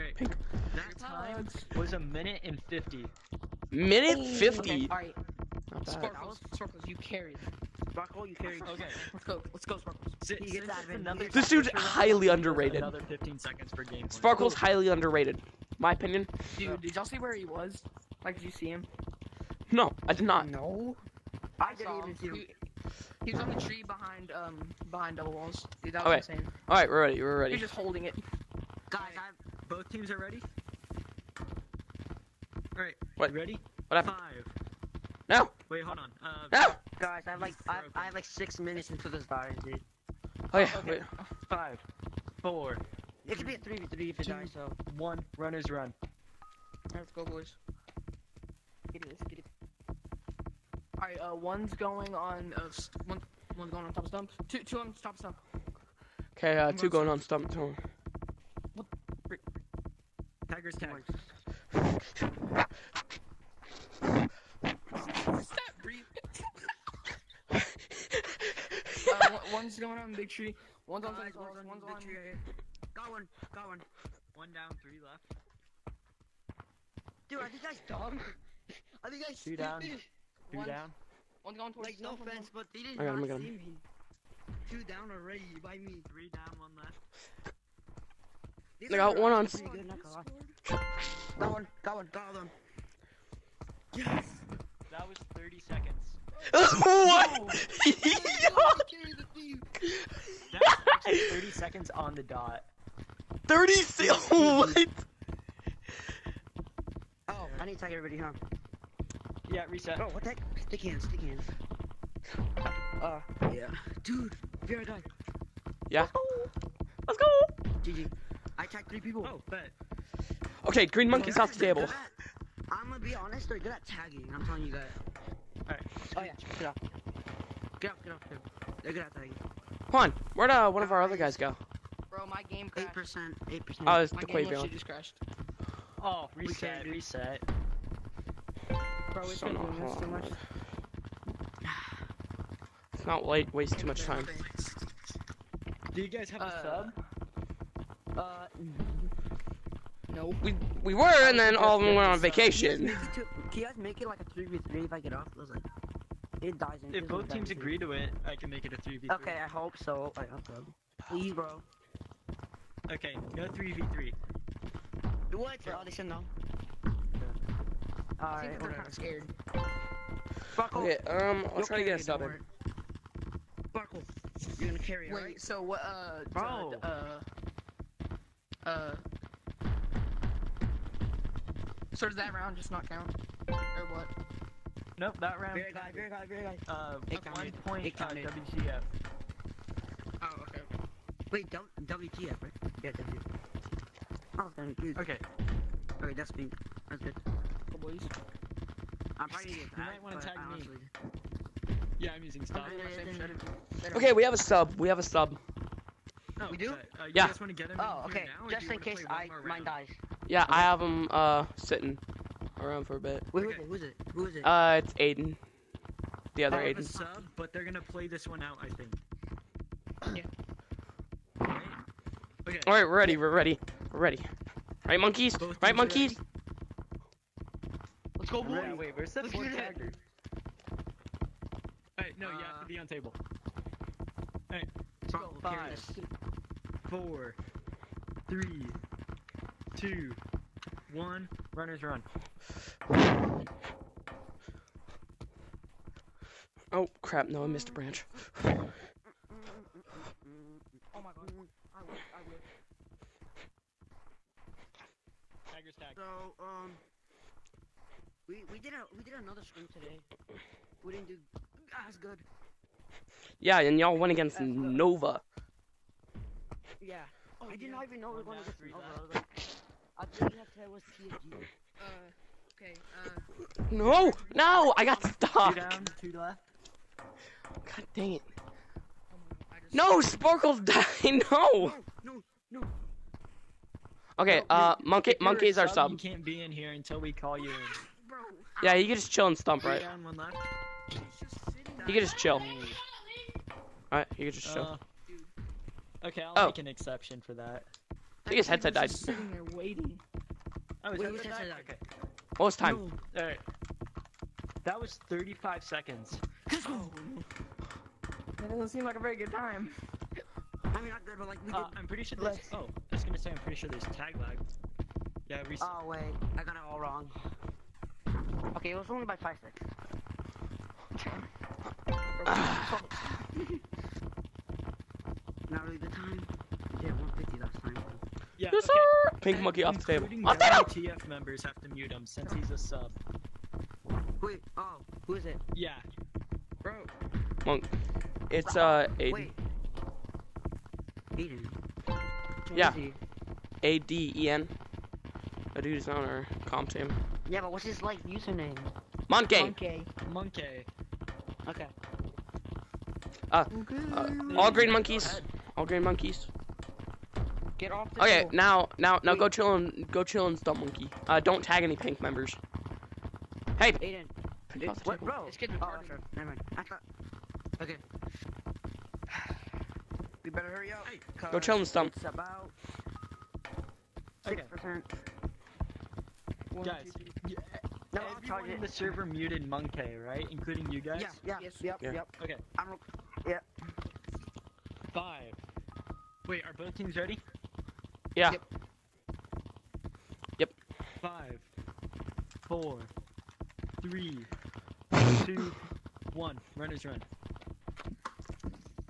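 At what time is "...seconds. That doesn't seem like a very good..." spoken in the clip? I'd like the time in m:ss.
5:05.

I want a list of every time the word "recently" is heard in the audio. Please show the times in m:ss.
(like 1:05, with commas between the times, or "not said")
5:15.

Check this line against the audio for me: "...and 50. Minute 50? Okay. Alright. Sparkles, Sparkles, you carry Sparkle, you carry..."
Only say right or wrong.
right.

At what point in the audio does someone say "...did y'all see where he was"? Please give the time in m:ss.
0:16.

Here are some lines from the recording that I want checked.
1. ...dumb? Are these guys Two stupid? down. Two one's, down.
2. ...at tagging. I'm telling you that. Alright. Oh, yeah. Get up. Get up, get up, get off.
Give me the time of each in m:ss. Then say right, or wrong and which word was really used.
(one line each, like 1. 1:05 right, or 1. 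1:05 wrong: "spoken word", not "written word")
1. 1:17 right
2. 2:03 right.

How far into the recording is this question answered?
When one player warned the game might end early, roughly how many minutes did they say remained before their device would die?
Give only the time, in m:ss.
0:38.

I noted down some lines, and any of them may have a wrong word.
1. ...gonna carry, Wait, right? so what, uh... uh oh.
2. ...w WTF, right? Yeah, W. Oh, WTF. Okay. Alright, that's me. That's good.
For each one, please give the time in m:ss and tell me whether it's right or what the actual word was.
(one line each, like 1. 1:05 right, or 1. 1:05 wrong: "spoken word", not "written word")
1. 2:54 right
2. 3:11 right.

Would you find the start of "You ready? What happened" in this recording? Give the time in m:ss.
0:33.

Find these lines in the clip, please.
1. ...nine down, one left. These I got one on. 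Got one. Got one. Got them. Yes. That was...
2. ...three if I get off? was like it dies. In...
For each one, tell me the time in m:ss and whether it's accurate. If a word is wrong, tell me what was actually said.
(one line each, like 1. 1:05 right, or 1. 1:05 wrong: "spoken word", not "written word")
1. 1:26 wrong: "three", not "nine"
2. 2:34 right.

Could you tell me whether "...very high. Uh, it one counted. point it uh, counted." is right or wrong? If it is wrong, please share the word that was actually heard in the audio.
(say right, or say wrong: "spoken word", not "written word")
right.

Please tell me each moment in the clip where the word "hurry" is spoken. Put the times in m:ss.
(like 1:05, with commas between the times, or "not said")
6:10.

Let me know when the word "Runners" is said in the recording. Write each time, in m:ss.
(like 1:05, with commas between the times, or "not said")
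0:45, 4:01, 6:36.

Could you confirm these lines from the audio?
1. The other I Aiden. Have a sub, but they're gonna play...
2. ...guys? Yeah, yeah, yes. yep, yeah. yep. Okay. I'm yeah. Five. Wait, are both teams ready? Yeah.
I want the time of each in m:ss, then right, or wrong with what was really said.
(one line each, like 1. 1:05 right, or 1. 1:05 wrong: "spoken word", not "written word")
1. 3:36 right
2. 6:20 right.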